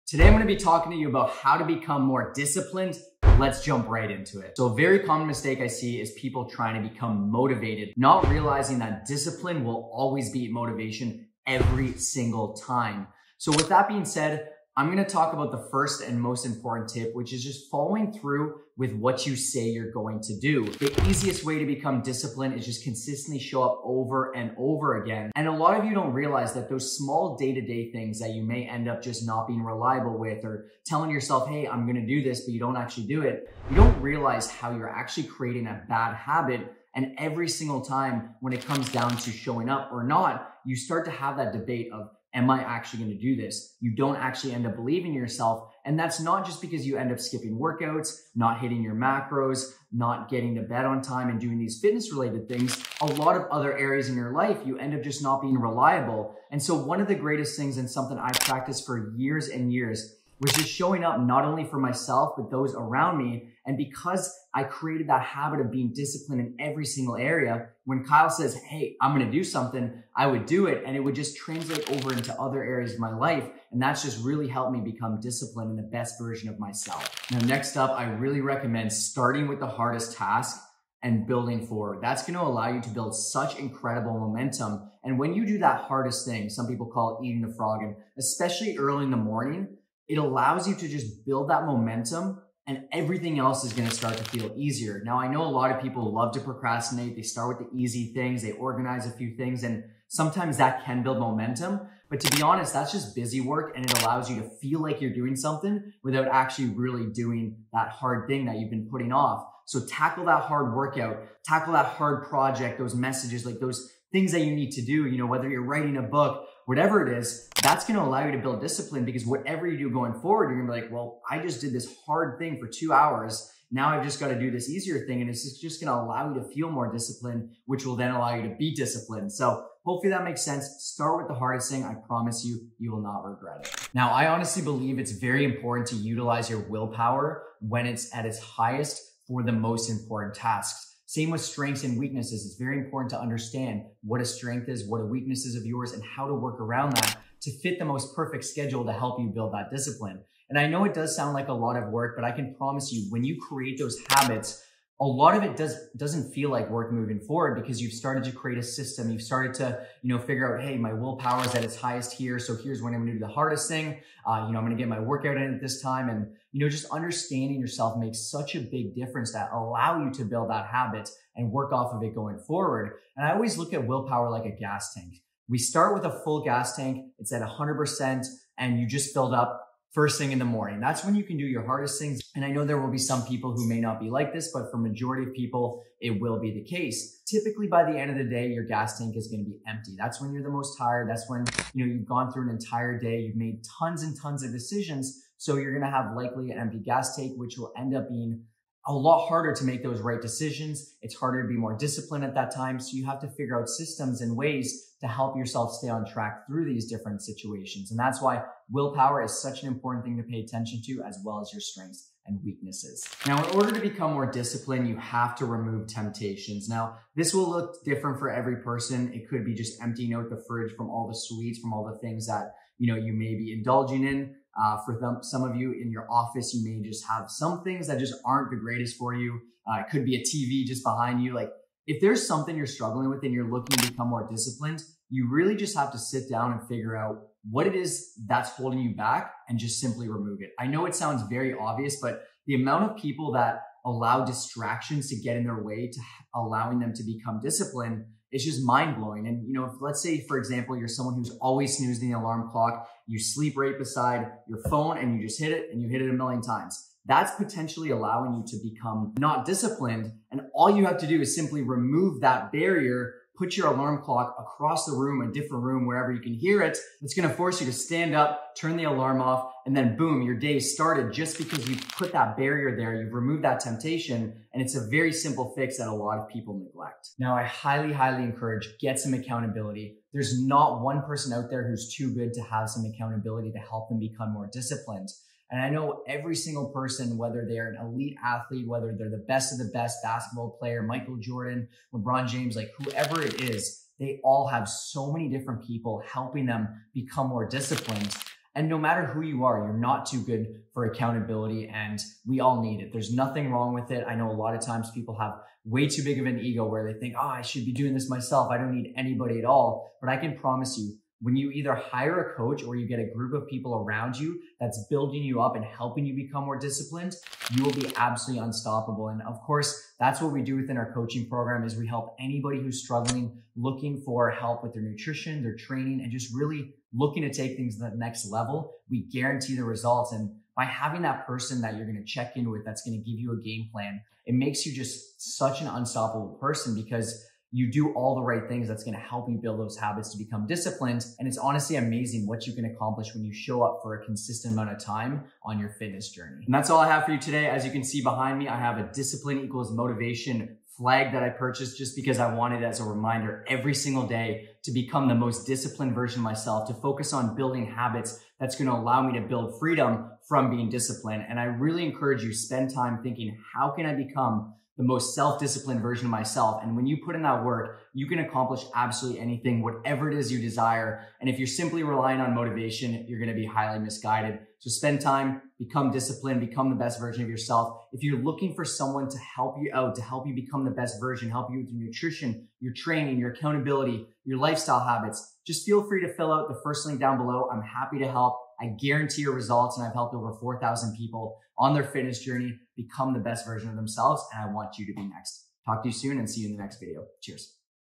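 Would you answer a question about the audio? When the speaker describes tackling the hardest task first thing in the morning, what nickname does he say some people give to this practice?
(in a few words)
Eating the frog.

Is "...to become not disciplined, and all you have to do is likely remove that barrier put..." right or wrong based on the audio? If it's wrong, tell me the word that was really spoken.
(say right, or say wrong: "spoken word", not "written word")
wrong: "simply", not "likely".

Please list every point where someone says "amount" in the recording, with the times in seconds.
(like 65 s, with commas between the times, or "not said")
242 s, 344 s.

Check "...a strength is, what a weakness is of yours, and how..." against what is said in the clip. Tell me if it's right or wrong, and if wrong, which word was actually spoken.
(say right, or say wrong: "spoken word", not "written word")
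right.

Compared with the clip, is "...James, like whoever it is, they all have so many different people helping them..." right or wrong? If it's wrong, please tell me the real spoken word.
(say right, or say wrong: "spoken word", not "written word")
right.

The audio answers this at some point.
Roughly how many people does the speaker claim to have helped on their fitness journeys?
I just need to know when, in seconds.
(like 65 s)
390 s.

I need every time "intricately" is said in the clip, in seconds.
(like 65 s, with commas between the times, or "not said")
not said.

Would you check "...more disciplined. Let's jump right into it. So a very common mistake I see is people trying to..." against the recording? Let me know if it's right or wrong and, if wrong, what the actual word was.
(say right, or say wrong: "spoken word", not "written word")
right.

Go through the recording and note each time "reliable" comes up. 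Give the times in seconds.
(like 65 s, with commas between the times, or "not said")
29 s, 55 s.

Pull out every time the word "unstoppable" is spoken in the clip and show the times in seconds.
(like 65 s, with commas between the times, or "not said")
318 s, 335 s.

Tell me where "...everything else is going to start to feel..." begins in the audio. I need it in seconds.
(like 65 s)
92 s.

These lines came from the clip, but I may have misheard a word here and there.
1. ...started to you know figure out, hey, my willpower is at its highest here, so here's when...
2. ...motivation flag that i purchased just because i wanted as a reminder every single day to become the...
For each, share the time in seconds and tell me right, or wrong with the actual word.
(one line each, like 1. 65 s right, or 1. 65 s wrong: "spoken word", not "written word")
1. 159 s right
2. 349 s right.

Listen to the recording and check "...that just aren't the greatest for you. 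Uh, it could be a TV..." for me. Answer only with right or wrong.
right.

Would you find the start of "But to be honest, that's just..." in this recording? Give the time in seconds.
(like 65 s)
102 s.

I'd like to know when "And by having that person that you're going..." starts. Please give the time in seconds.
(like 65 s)
330 s.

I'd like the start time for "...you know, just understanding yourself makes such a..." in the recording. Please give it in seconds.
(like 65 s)
166 s.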